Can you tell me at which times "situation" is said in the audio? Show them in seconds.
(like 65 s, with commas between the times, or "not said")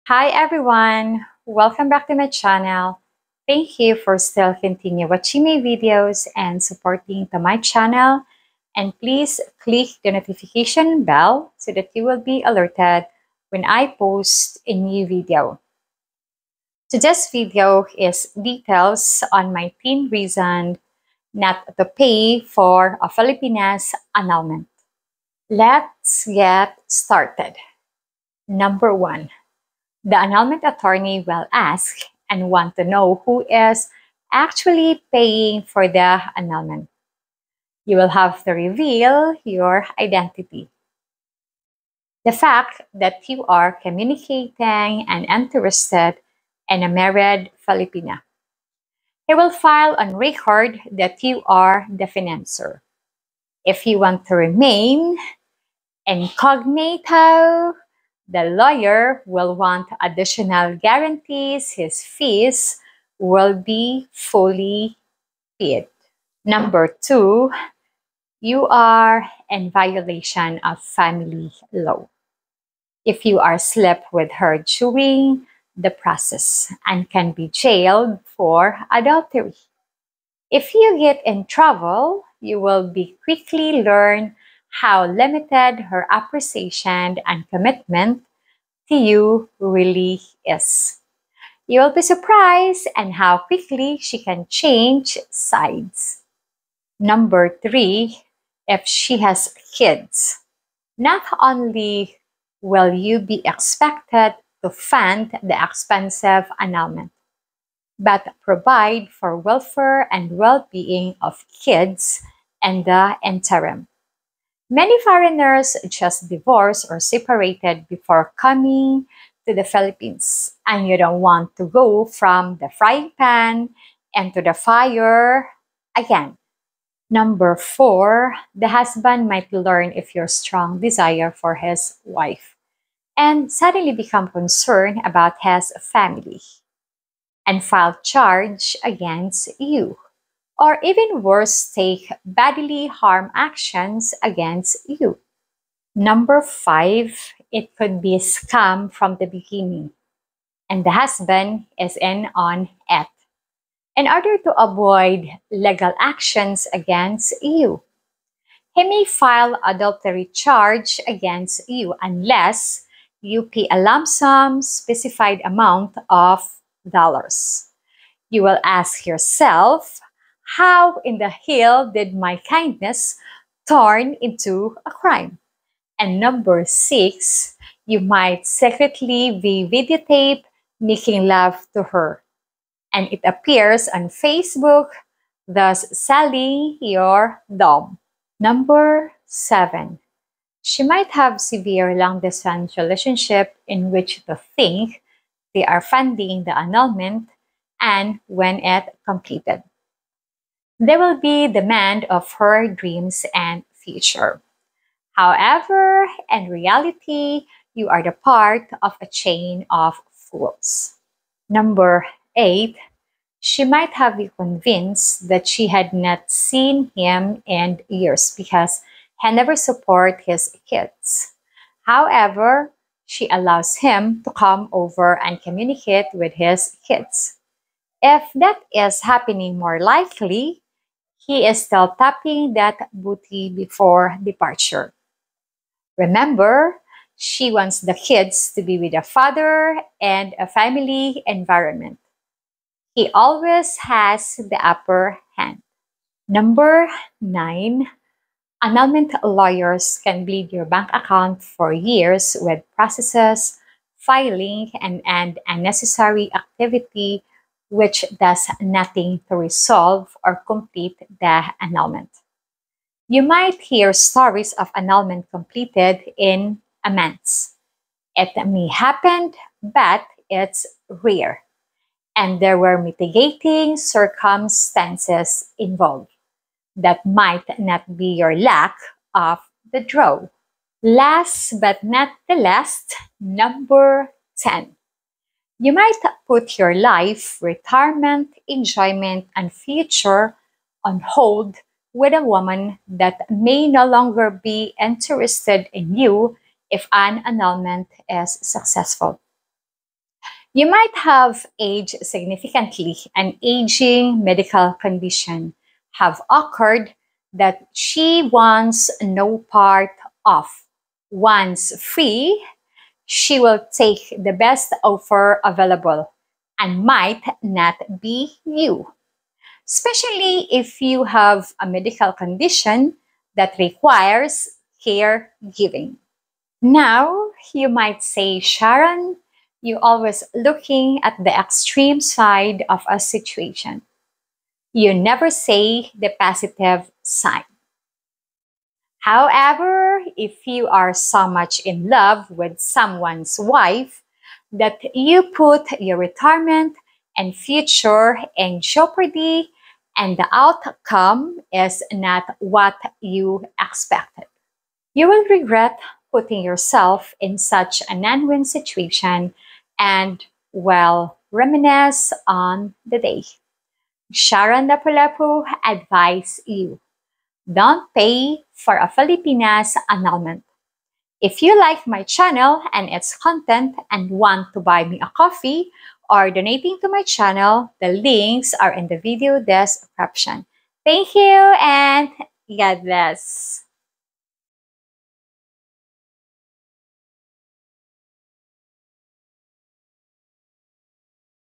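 332 s, 358 s.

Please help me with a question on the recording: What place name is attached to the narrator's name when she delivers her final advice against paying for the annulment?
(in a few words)
LapuLapu.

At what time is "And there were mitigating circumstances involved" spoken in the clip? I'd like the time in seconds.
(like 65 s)
272 s.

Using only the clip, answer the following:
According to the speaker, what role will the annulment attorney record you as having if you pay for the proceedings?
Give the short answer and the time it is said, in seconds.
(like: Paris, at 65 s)
financer, at 52 s.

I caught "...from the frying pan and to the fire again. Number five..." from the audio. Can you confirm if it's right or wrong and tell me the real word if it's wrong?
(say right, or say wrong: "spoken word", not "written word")
wrong: "four", not "five".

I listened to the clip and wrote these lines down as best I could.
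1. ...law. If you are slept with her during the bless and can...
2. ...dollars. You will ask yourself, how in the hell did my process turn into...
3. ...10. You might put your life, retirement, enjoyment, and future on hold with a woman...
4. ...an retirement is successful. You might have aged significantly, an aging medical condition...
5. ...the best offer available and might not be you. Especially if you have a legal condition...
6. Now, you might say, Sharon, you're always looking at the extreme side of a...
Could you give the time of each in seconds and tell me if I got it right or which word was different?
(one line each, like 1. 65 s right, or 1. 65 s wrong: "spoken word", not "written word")
1. 71 s wrong: "process", not "bless"
2. 166 s wrong: "kindness", not "process"
3. 284 s right
4. 296 s wrong: "annulment", not "retirement"
5. 314 s wrong: "medical", not "legal"
6. 326 s right.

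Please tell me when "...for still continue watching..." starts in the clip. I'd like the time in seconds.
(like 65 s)
3 s.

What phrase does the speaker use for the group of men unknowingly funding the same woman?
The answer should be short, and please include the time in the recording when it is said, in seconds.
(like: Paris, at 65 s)
chain of fools, at 209 s.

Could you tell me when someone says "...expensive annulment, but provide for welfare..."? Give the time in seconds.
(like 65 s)
105 s.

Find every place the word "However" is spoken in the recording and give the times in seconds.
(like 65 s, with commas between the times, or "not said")
205 s, 221 s, 339 s.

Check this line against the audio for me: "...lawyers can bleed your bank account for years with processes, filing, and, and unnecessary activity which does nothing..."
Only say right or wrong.
right.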